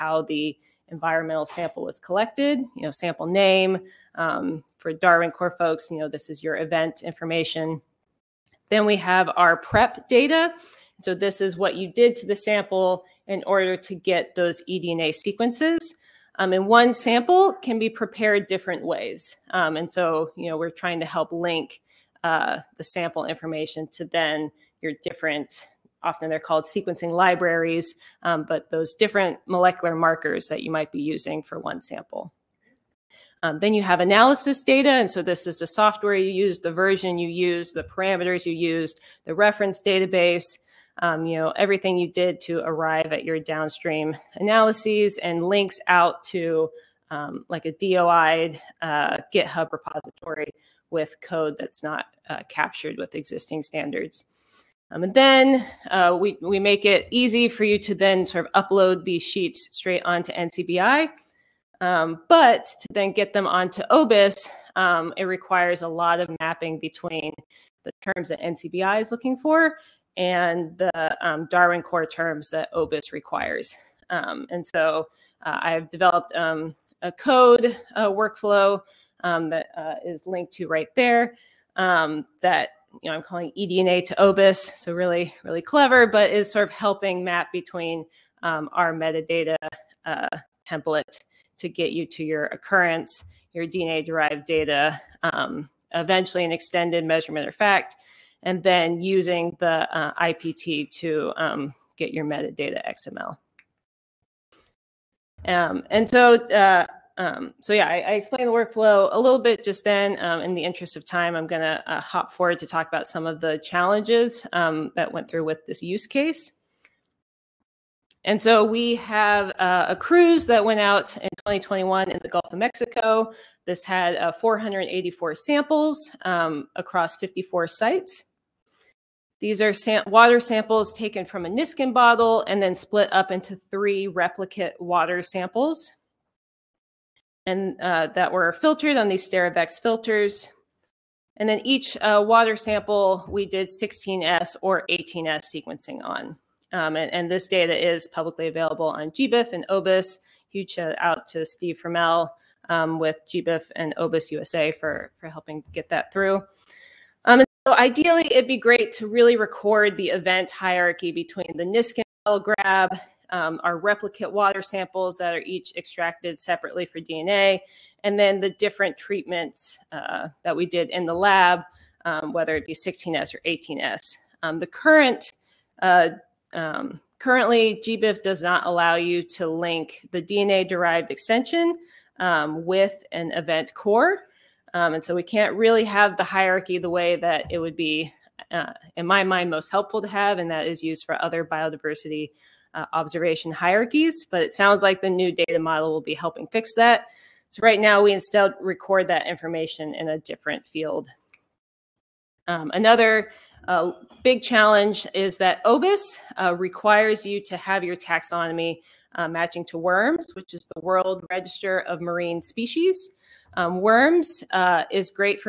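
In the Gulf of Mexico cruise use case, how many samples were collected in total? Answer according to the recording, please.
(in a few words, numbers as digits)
484.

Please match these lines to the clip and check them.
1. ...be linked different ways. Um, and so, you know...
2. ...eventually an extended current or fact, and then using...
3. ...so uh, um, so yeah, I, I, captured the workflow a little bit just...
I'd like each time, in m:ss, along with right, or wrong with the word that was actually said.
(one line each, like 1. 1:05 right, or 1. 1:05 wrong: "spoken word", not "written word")
1. 0:17 wrong: "prepared", not "linked"
2. 1:35 wrong: "measurement", not "current"
3. 1:46 wrong: "explained", not "captured".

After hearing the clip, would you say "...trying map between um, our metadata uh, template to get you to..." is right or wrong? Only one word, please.
wrong.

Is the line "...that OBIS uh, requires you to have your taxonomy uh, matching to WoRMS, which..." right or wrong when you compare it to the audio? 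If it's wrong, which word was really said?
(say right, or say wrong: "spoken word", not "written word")
right.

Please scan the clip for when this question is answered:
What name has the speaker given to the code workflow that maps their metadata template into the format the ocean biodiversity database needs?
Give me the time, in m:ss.
1:23.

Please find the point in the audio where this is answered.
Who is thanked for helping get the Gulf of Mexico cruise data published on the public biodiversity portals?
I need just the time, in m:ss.
2:31.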